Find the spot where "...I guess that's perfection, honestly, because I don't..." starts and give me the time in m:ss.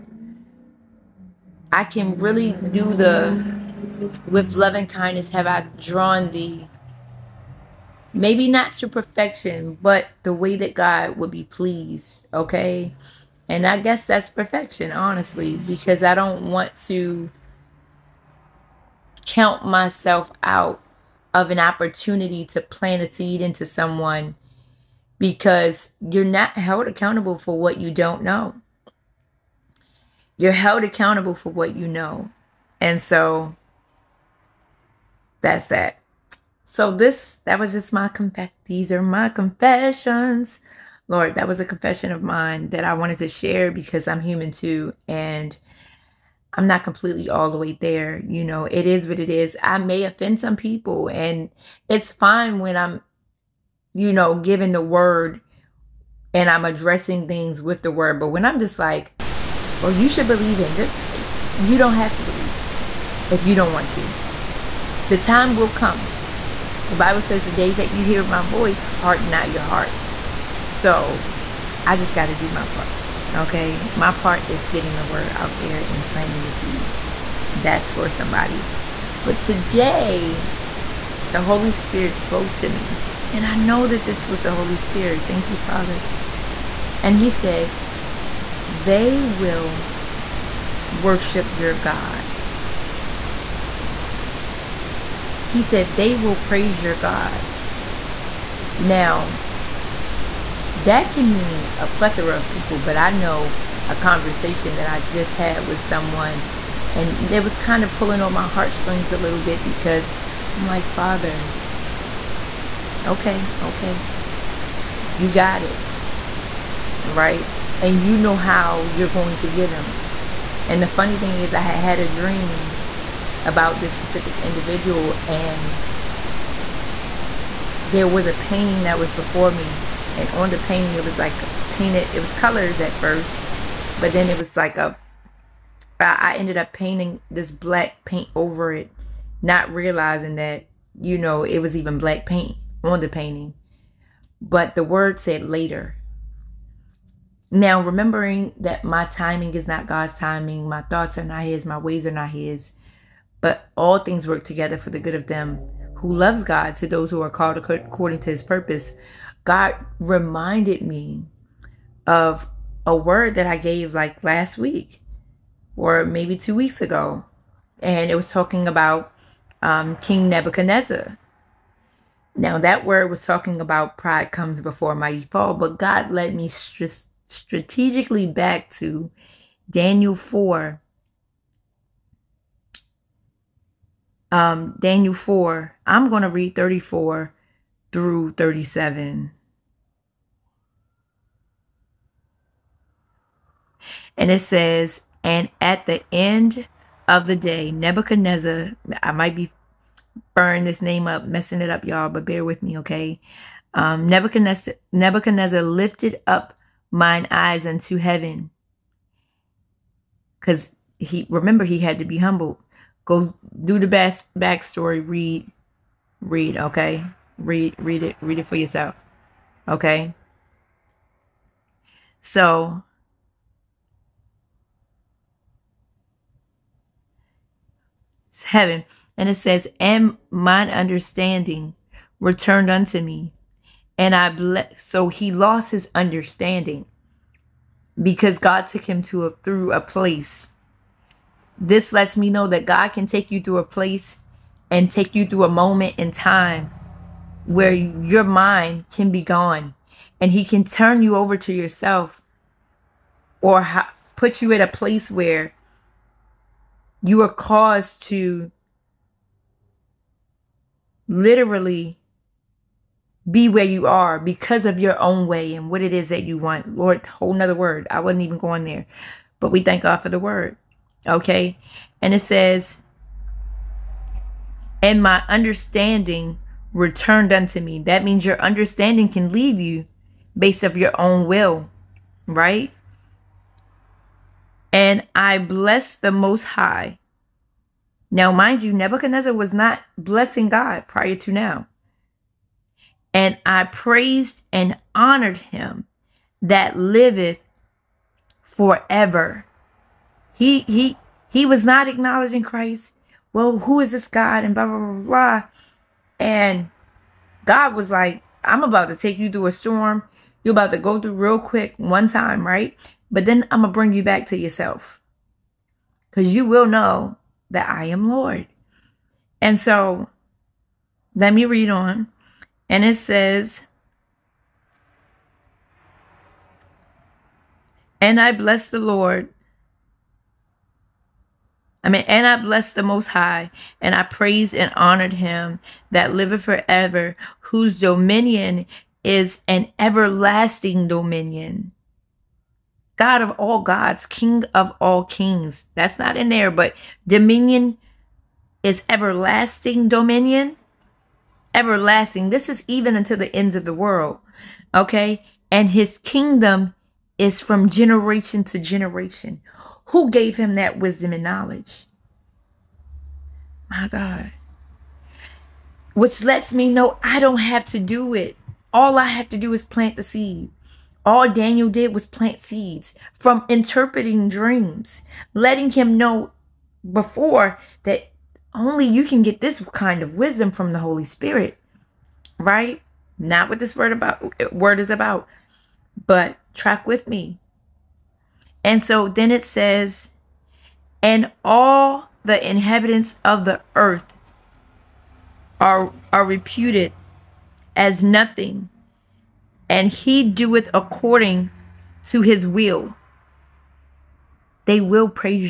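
0:13.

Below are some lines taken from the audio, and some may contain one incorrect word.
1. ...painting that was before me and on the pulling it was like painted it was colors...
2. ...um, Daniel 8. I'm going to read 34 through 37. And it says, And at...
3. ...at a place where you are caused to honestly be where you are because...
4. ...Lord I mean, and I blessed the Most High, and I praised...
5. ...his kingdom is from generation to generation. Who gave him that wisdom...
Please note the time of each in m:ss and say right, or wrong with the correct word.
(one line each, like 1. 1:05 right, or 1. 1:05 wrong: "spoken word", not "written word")
1. 2:08 wrong: "painting", not "pulling"
2. 3:04 wrong: "4", not "8"
3. 4:14 wrong: "literally", not "honestly"
4. 5:28 right
5. 5:55 right.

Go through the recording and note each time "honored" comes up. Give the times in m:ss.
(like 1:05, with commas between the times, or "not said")
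4:54, 5:34.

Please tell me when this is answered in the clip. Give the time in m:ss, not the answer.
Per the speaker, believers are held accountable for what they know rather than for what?
0:27.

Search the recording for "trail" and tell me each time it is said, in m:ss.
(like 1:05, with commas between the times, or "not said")
not said.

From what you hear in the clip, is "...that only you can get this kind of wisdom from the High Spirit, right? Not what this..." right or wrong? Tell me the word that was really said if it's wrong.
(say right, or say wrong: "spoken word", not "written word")
wrong: "Holy", not "High".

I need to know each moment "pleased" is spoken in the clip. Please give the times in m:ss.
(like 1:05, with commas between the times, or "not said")
0:11.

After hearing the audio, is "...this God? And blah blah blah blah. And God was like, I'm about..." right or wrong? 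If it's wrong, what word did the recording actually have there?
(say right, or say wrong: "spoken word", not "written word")
right.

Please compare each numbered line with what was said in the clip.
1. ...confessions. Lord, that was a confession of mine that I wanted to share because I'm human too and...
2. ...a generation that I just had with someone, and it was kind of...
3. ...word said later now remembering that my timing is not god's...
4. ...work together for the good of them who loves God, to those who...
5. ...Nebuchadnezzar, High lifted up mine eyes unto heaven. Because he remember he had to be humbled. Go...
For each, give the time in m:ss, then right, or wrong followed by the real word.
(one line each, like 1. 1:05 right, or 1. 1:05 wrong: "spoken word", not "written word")
1. 0:39 right
2. 1:43 wrong: "conversation", not "generation"
3. 2:24 right
4. 2:34 right
5. 3:24 wrong: "Nebuchadnezzar", not "High".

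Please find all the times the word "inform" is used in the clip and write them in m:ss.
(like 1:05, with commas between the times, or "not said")
not said.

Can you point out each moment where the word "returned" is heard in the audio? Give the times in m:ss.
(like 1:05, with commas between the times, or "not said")
3:52, 4:36.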